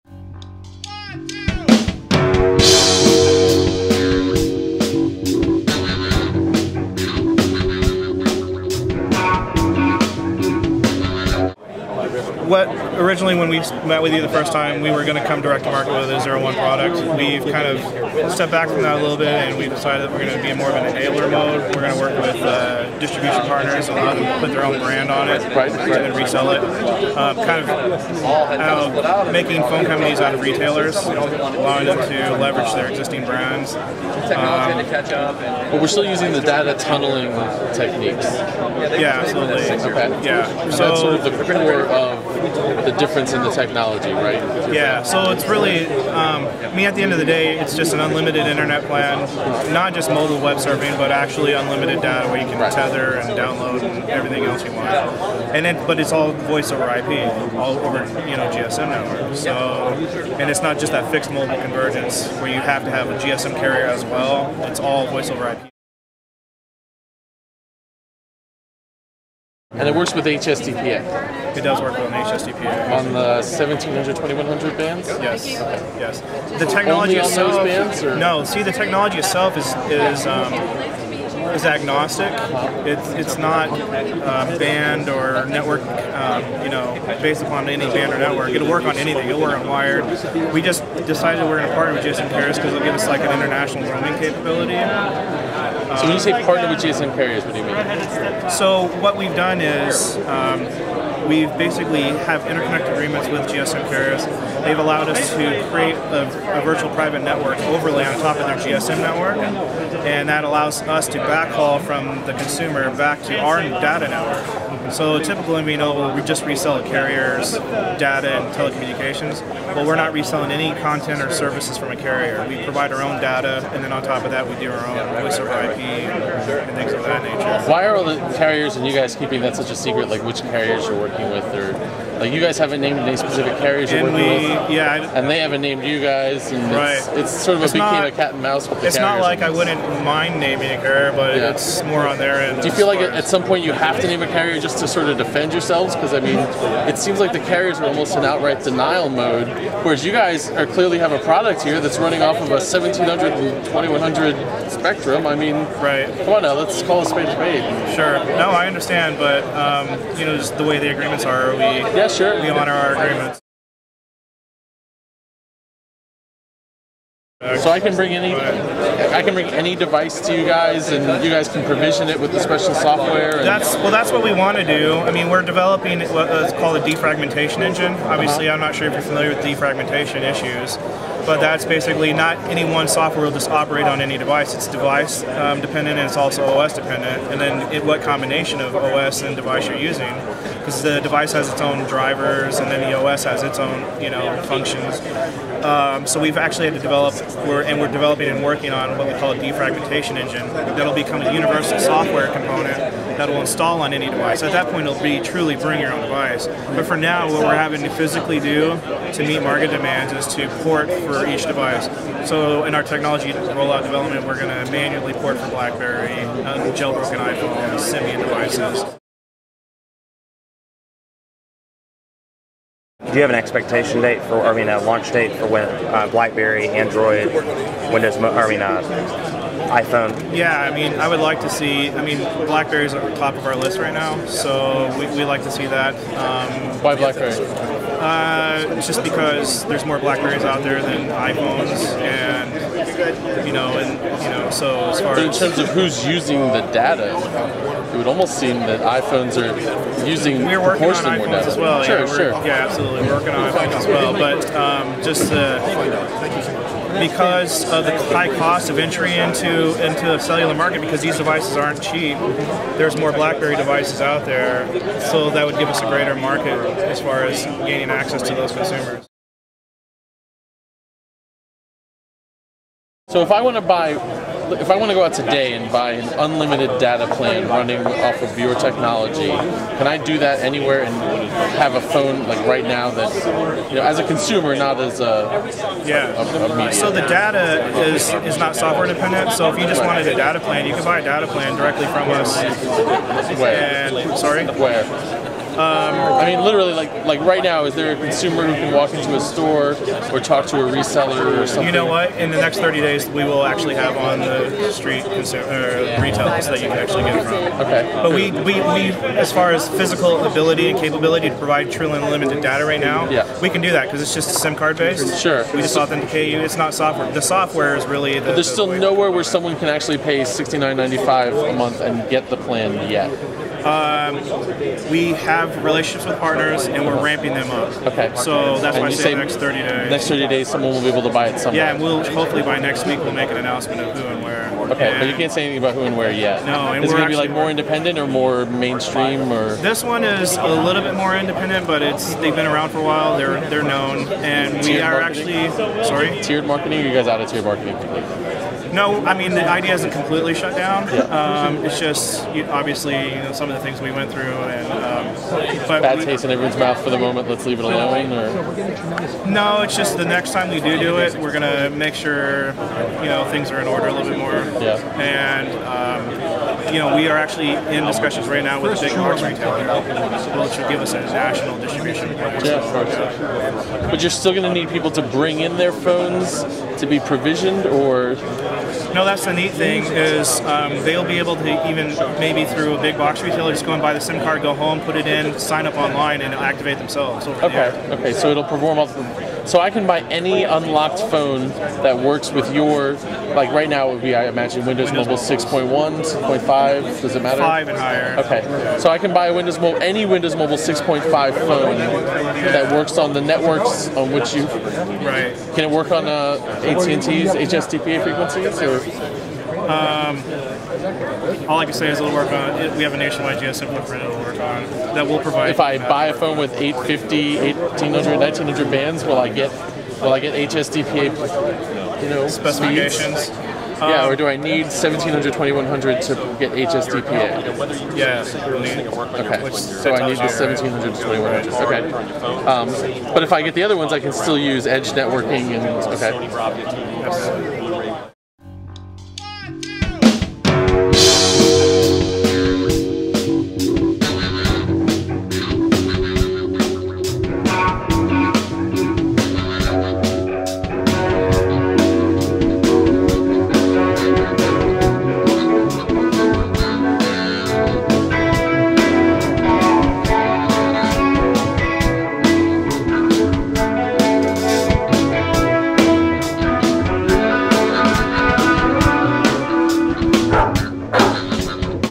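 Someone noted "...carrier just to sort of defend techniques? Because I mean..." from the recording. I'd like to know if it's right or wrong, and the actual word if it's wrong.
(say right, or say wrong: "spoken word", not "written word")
wrong: "yourselves", not "techniques".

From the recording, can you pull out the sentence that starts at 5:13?
we can do that because it's just SIM card based.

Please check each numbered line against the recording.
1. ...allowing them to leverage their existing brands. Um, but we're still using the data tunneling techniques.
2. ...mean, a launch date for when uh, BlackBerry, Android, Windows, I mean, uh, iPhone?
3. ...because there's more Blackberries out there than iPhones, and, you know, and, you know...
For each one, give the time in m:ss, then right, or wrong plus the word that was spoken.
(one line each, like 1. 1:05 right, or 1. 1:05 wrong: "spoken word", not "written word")
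1. 0:31 right
2. 3:44 right
3. 3:59 right.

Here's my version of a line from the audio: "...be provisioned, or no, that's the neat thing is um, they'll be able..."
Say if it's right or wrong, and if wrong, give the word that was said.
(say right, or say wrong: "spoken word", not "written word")
right.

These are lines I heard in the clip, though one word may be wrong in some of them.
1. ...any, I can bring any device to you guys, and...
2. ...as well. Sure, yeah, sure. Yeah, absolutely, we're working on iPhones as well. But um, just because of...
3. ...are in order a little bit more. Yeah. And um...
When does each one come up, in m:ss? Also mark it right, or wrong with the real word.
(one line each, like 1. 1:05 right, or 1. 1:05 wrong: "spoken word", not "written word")
1. 2:48 right
2. 4:11 right
3. 6:03 right.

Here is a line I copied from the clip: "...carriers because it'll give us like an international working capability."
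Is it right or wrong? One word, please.
wrong.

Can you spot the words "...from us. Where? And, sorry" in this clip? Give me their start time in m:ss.
4:51.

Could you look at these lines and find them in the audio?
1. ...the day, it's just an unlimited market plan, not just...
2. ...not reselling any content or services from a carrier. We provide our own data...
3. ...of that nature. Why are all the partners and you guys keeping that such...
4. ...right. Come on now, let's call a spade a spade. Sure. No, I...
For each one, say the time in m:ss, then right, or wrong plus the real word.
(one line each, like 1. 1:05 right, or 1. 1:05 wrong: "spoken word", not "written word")
1. 0:47 wrong: "internet", not "market"
2. 1:59 right
3. 2:06 wrong: "carriers", not "partners"
4. 2:35 right.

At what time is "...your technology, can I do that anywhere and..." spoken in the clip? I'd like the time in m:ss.
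4:38.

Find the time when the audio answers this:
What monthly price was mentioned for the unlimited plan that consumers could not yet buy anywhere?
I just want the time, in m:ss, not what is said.
5:20.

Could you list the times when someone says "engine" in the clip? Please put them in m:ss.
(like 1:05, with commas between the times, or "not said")
2:57, 3:20.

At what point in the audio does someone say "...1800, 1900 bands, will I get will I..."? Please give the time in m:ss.
6:57.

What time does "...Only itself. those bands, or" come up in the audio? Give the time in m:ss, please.
1:17.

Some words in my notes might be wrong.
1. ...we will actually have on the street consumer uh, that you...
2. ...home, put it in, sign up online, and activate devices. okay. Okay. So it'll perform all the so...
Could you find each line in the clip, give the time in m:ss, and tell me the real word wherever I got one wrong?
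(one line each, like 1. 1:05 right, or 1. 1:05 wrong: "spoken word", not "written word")
1. 5:03 right
2. 6:24 wrong: "themselves", not "devices".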